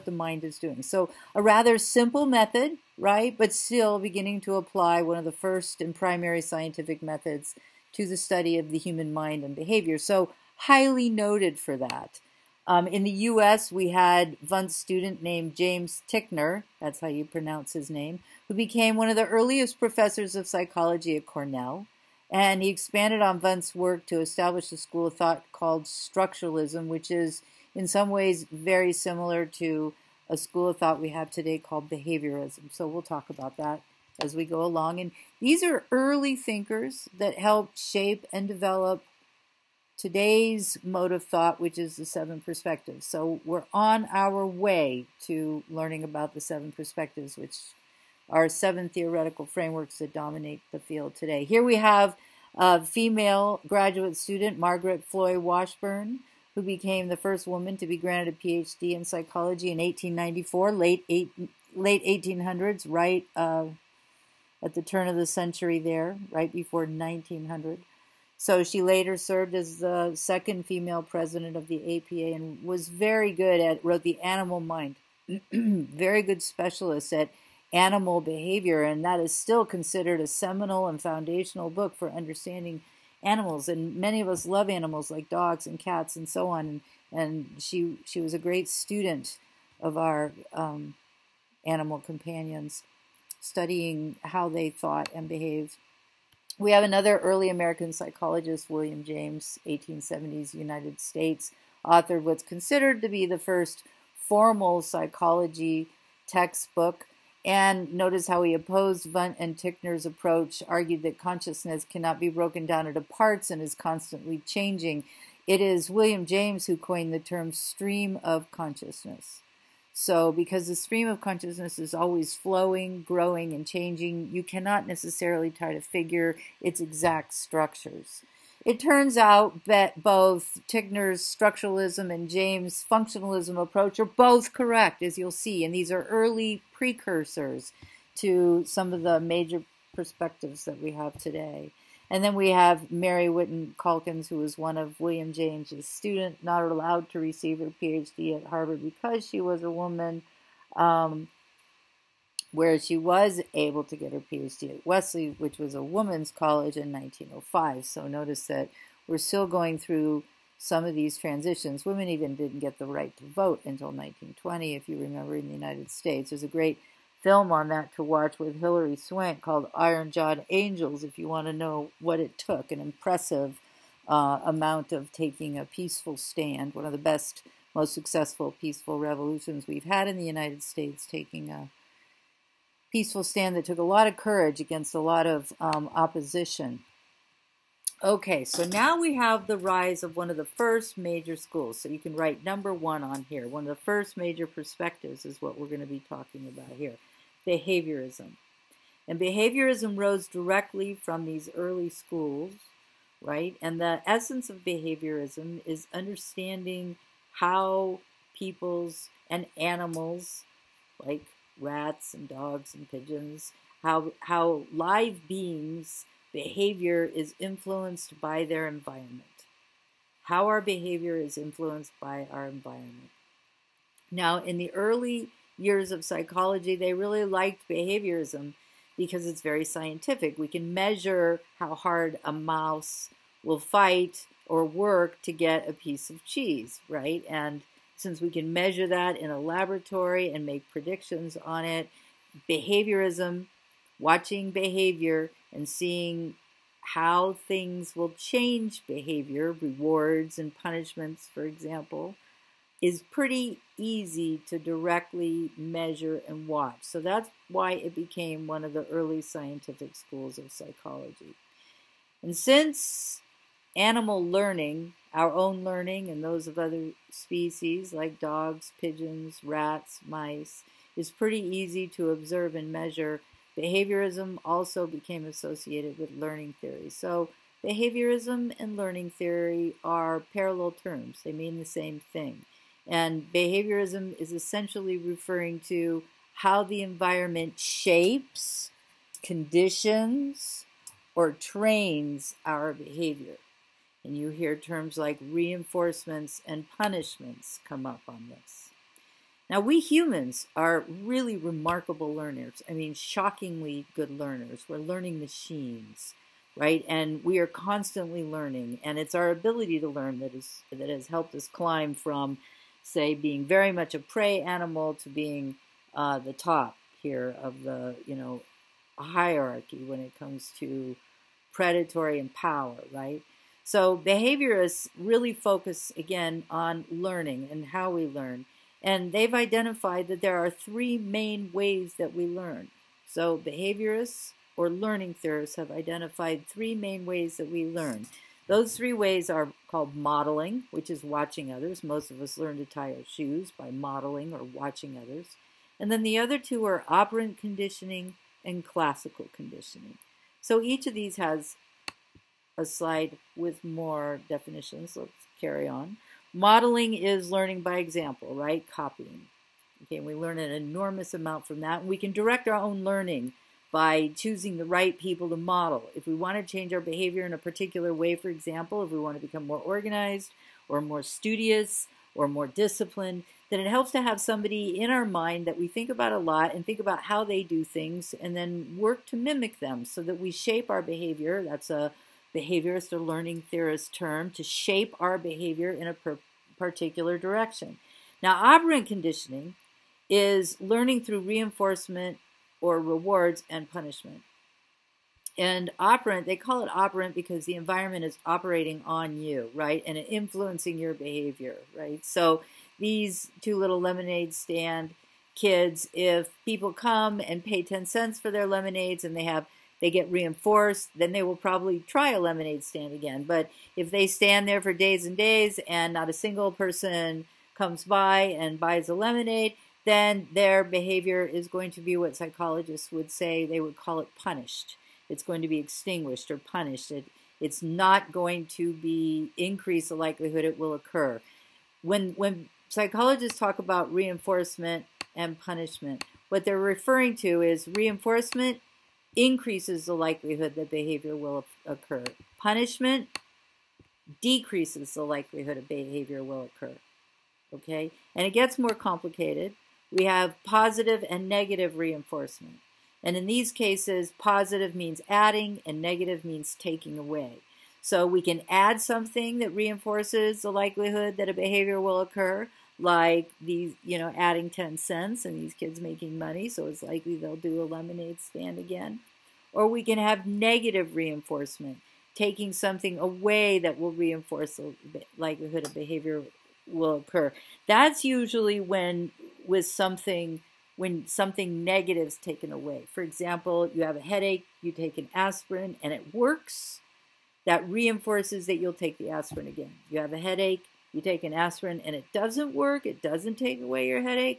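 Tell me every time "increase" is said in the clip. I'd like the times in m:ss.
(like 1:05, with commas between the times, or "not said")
7:09, 7:19.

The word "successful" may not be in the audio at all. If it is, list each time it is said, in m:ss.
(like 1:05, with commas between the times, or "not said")
2:57.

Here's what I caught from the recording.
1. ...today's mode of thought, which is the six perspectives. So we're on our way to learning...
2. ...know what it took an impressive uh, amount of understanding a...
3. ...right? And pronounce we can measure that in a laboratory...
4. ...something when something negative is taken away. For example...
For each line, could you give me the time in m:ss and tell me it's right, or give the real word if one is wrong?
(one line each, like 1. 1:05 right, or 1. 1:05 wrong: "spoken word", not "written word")
1. 0:39 wrong: "seven", not "six"
2. 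2:51 wrong: "taking", not "understanding"
3. 3:56 wrong: "since", not "pronounce"
4. 7:59 right.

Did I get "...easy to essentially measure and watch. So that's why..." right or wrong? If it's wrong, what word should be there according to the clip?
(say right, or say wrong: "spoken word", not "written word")
wrong: "directly", not "essentially".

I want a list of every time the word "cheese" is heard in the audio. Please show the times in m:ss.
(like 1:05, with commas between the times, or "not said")
3:56.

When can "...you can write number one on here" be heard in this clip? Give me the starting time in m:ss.
3:11.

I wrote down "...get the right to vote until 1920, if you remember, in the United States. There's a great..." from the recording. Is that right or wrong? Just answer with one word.
right.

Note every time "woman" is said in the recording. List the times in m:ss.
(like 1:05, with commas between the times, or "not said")
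0:57, 2:29.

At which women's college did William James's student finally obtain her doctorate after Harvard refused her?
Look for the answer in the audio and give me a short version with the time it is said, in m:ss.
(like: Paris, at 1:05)
Wellesley, at 2:34.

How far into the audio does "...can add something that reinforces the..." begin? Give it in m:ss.
7:38.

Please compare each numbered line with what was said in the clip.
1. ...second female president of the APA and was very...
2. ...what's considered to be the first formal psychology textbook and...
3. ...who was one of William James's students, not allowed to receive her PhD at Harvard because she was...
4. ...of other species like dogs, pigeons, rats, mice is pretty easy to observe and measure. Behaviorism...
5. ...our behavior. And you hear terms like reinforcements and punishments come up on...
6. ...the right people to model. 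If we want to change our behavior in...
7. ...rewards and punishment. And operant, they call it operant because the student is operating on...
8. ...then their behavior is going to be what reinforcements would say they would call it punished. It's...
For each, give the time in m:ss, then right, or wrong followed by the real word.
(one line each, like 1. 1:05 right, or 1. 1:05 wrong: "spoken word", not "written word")
1. 1:10 right
2. 1:42 right
3. 2:24 right
4. 4:26 right
5. 4:52 right
6. 6:04 right
7. 6:32 wrong: "environment", not "student"
8. 6:59 wrong: "psychologists", not "reinforcements".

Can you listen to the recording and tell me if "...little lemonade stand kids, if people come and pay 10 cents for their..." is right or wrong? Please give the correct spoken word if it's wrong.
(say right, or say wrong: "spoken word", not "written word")
right.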